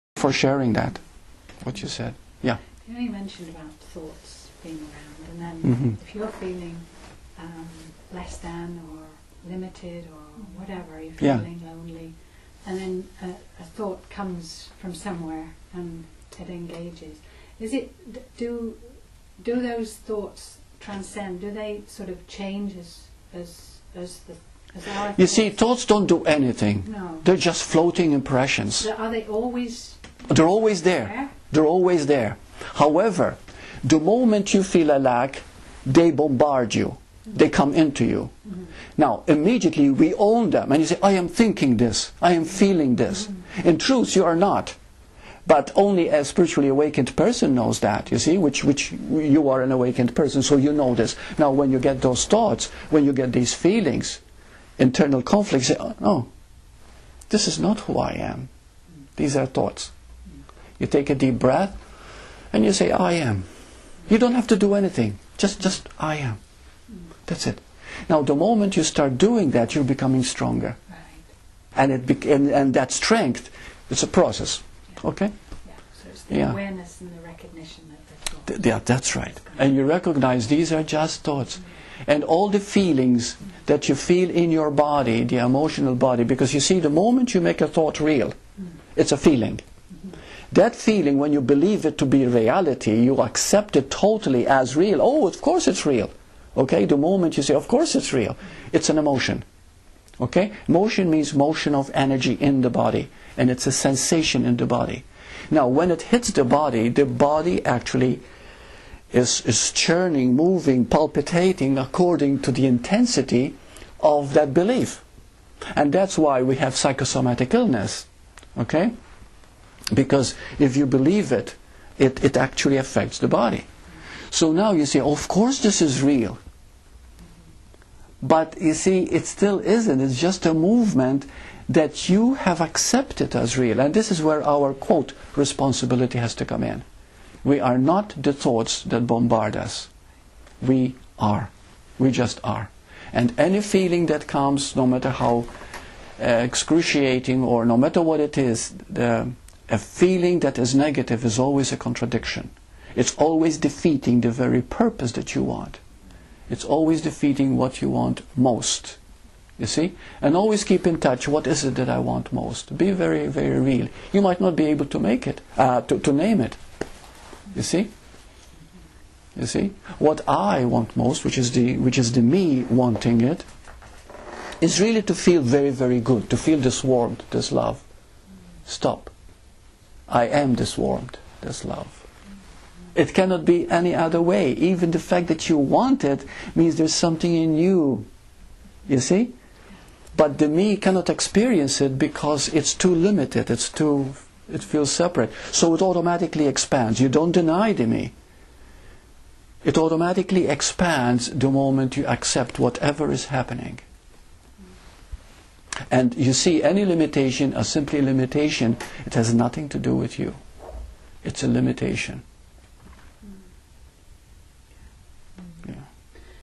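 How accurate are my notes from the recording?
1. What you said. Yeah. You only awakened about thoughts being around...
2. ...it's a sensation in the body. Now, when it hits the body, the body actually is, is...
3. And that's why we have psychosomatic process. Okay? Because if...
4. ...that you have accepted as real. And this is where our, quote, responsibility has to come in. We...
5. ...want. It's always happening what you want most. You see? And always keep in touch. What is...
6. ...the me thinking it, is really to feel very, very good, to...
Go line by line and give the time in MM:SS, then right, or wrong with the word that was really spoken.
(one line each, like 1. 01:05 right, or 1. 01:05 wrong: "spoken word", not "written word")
1. 00:01 wrong: "mentioned", not "awakened"
2. 01:43 right
3. 01:55 wrong: "illness", not "process"
4. 02:11 right
5. 02:35 wrong: "defeating", not "happening"
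6. 02:52 wrong: "wanting", not "thinking".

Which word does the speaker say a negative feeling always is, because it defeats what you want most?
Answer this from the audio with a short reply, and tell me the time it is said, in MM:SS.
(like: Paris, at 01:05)
a contradiction, at 02:31.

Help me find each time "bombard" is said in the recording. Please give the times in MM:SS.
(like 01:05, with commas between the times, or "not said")
00:36, 02:19.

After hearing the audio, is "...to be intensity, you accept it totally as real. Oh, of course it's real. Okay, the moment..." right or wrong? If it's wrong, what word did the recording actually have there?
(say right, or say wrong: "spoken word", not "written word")
wrong: "reality", not "intensity".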